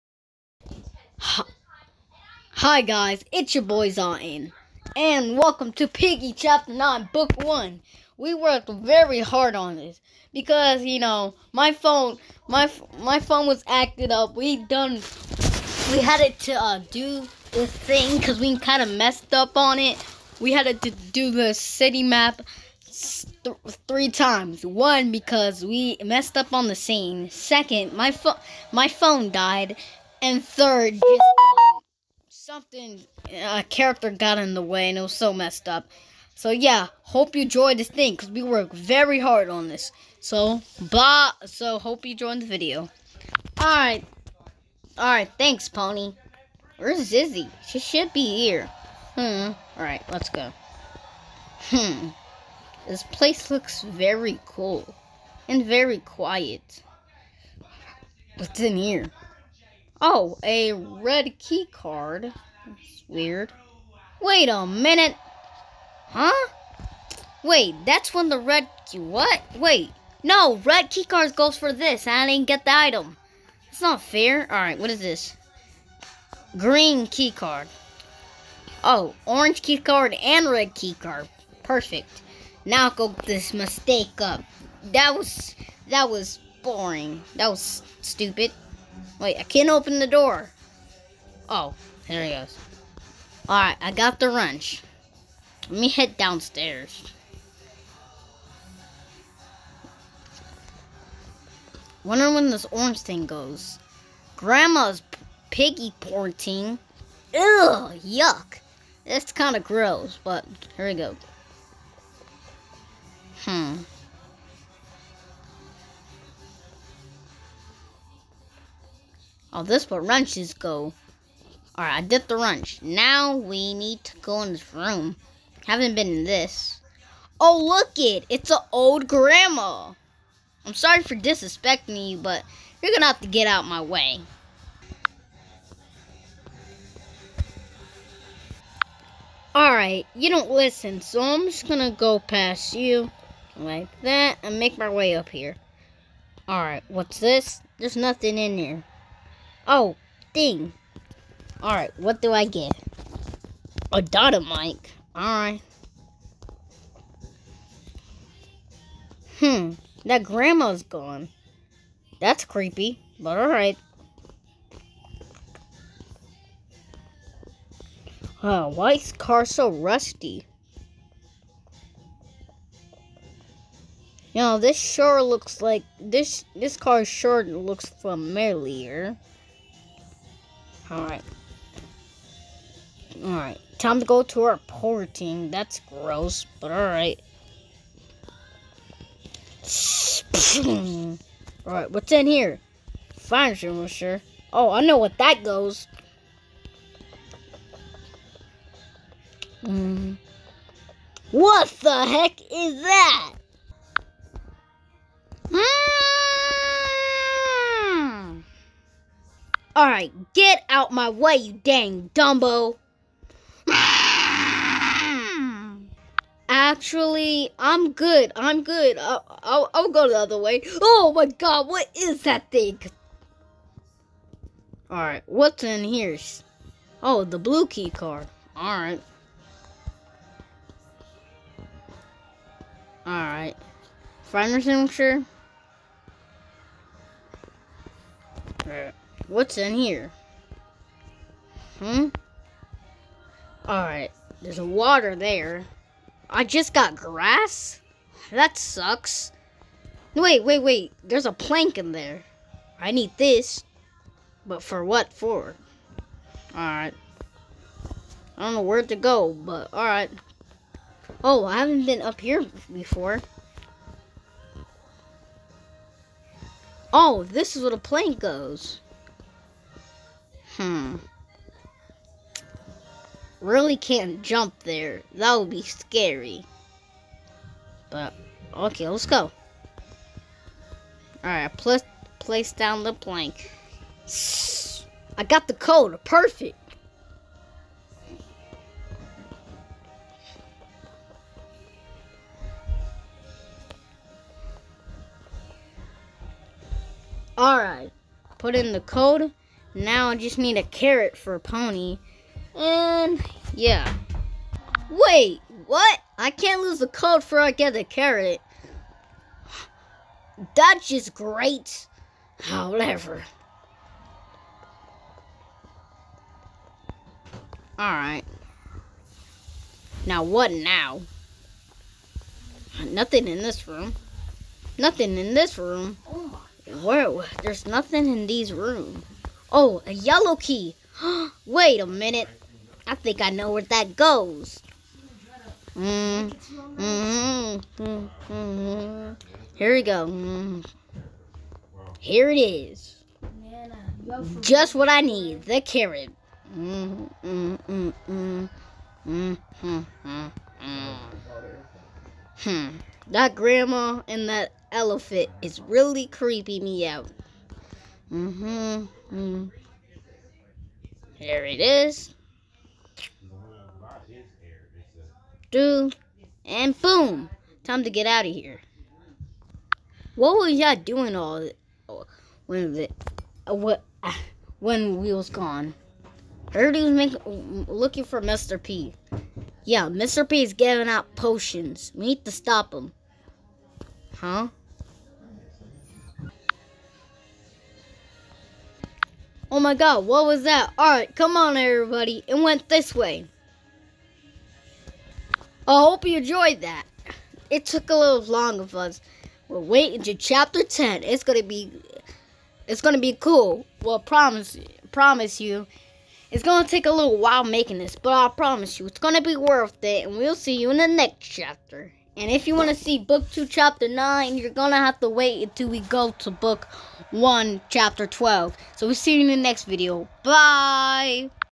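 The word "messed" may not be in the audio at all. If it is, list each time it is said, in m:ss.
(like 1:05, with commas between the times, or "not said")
0:18, 0:26, 0:35.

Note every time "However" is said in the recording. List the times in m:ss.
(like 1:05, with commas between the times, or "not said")
5:12.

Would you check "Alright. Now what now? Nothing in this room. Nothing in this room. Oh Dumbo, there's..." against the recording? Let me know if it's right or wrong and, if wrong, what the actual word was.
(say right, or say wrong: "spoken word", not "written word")
wrong: "Whoa", not "Dumbo".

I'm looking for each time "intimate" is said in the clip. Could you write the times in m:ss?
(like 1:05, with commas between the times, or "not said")
not said.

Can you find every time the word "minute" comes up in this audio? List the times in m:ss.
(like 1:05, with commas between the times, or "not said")
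1:04, 5:31.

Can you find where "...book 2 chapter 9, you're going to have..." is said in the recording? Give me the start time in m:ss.
6:52.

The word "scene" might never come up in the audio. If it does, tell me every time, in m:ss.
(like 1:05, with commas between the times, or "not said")
0:26.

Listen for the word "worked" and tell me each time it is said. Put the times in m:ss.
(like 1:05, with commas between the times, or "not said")
0:08, 0:38.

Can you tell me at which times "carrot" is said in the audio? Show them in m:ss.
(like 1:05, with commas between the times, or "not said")
5:00, 5:07, 5:45.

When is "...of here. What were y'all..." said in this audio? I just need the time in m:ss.
6:08.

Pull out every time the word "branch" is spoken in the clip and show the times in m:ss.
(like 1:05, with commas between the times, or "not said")
not said.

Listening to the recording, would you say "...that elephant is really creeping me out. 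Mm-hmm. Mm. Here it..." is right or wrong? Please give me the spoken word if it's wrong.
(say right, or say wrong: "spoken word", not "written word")
right.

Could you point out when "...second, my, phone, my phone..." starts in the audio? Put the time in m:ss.
0:27.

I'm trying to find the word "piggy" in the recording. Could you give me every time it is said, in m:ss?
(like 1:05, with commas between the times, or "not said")
0:05, 1:45.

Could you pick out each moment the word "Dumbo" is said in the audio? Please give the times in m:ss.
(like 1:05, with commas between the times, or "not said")
3:32.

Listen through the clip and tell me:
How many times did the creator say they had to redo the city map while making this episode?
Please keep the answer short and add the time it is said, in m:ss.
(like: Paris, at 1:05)
3, at 0:23.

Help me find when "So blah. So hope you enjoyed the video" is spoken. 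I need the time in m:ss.
0:40.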